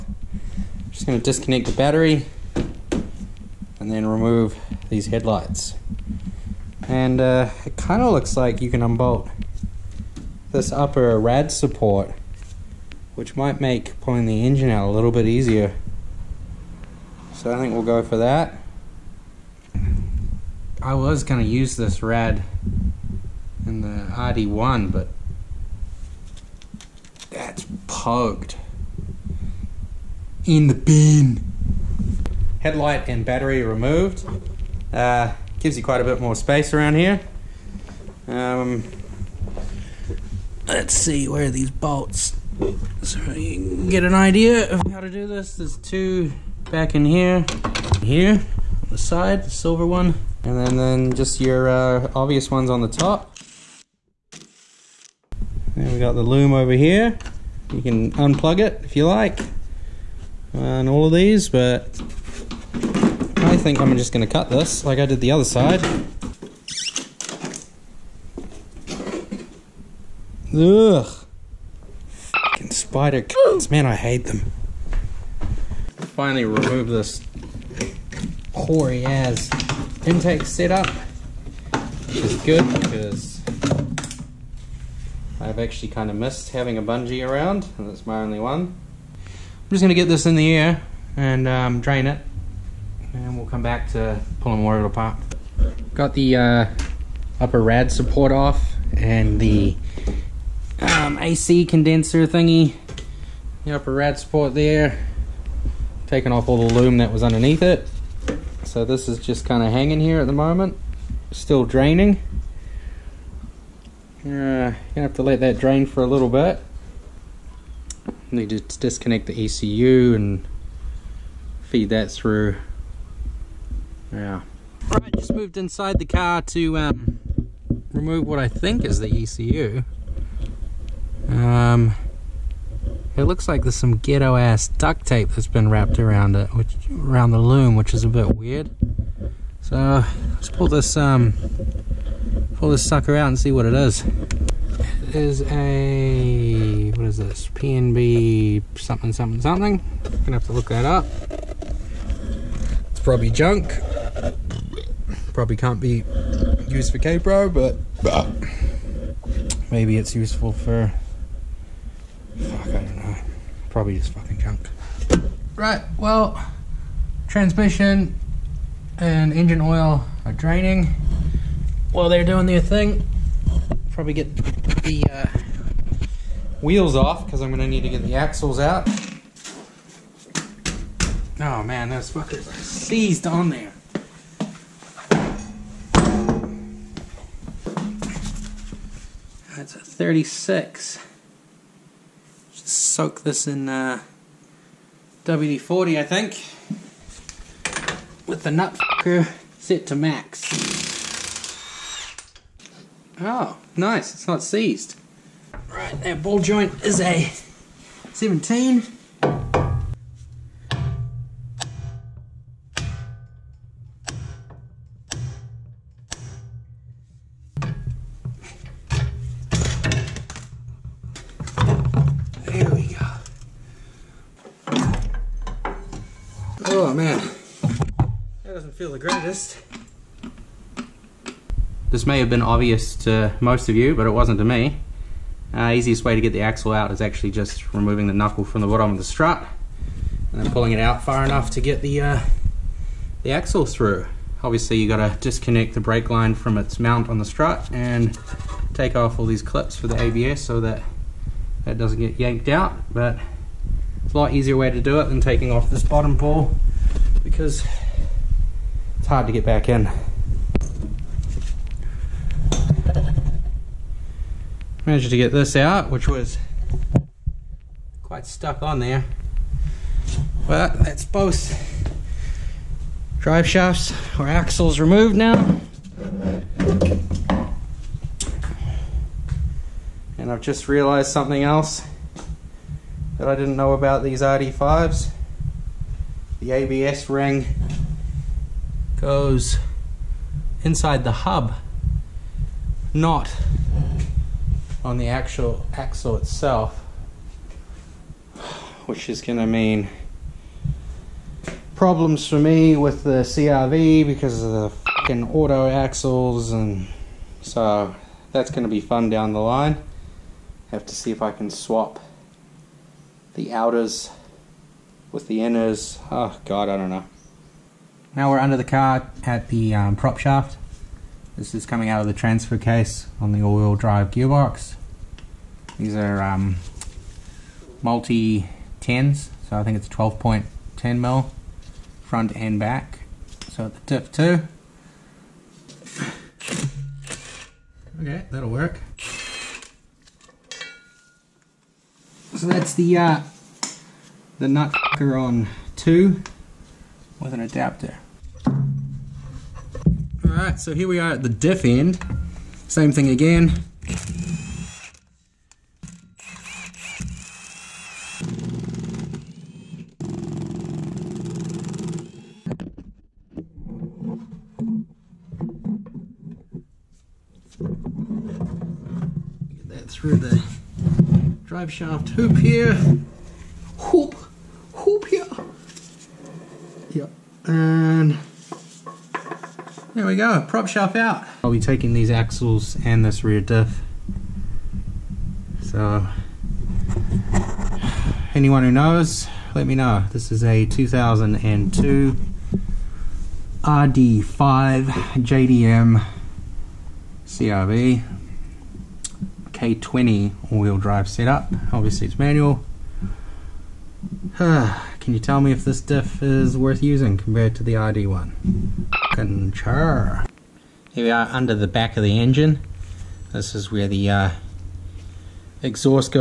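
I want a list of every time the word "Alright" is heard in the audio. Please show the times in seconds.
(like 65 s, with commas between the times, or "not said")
124 s, 350 s.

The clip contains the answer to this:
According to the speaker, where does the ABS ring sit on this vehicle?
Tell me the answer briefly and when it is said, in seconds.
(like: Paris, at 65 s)
inside the hub, at 290 s.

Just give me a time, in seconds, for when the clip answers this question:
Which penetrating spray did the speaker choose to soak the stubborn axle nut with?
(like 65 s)
195 s.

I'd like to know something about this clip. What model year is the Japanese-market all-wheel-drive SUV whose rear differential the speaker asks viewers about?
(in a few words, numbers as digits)
2002.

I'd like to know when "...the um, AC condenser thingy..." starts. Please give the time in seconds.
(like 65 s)
99 s.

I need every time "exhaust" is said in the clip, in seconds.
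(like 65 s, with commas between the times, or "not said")
415 s.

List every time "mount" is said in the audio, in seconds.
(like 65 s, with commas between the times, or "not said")
246 s.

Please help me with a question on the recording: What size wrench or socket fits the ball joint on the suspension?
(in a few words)
17.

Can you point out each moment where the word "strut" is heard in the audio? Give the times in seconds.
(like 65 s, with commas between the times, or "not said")
239 s, 247 s.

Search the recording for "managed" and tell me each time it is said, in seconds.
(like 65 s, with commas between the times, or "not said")
264 s.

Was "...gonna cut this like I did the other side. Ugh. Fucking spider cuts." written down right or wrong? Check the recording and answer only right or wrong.
right.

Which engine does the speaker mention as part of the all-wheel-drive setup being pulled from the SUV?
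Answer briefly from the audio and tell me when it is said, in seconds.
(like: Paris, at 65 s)
K20, at 399 s.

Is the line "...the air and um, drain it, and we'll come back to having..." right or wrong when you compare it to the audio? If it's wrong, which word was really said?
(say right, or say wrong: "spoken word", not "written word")
wrong: "pulling", not "having".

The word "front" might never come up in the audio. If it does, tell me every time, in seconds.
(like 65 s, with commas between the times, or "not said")
332 s.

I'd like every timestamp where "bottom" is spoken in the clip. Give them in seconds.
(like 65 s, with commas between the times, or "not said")
238 s, 255 s.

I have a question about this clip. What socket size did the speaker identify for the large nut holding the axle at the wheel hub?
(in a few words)
36.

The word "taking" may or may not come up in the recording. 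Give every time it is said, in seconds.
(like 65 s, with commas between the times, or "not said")
106 s, 255 s, 381 s.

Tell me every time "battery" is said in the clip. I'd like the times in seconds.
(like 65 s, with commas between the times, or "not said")
1 s, 33 s.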